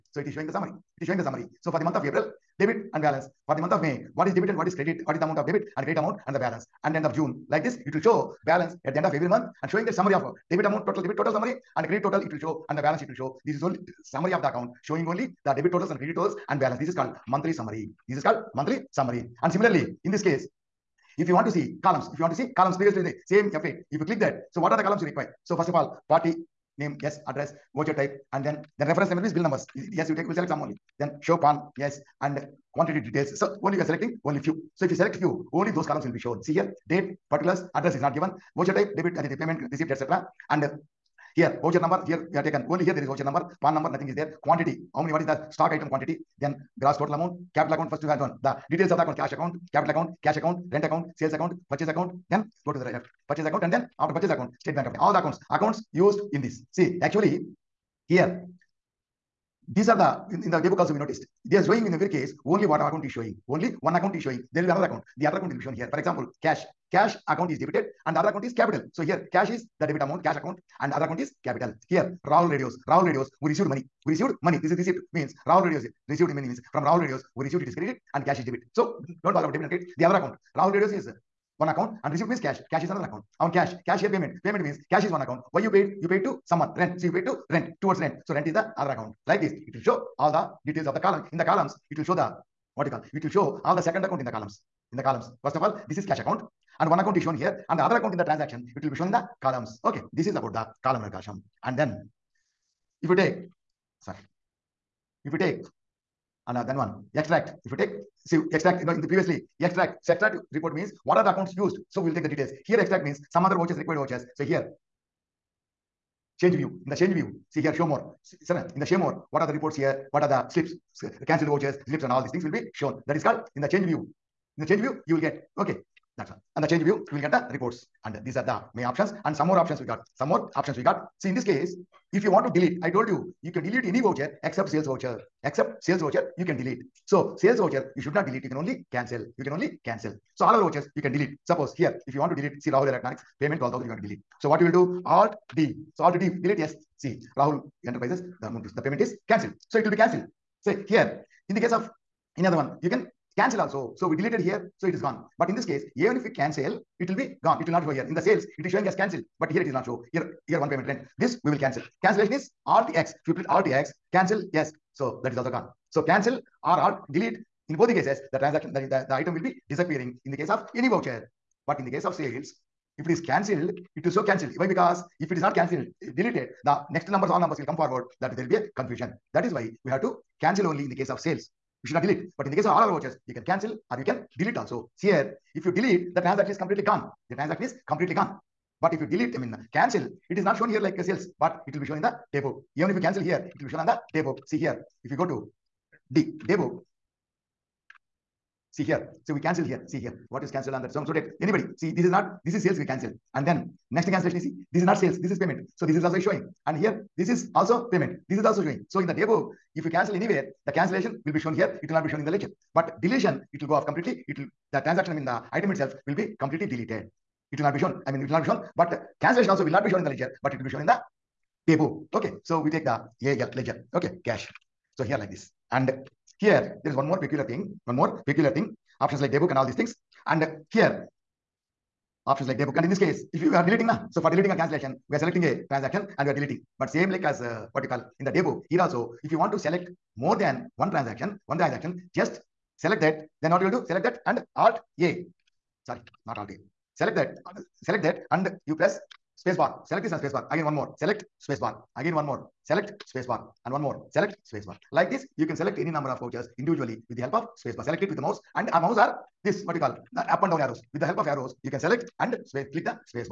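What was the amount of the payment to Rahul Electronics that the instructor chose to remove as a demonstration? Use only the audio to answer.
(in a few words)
12,000.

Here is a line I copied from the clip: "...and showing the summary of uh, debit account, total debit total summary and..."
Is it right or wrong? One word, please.
wrong.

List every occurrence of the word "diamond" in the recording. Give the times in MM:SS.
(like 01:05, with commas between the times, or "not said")
not said.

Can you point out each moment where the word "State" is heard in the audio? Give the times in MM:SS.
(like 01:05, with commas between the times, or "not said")
00:54.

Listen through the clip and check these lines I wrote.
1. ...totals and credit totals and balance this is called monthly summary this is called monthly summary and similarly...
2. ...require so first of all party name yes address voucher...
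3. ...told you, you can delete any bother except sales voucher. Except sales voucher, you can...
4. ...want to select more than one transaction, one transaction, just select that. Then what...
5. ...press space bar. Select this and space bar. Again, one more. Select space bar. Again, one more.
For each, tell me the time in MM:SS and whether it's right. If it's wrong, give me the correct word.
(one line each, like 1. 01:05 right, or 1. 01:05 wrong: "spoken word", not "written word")
1. 00:15 right
2. 00:25 right
3. 02:12 wrong: "voucher", not "bother"
4. 03:59 right
5. 04:08 right.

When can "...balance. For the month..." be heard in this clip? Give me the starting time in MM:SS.
00:03.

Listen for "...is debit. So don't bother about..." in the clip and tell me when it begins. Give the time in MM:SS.
01:18.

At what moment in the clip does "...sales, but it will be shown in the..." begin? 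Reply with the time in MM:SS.
03:11.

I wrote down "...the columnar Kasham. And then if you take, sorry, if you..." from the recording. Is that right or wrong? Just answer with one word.
right.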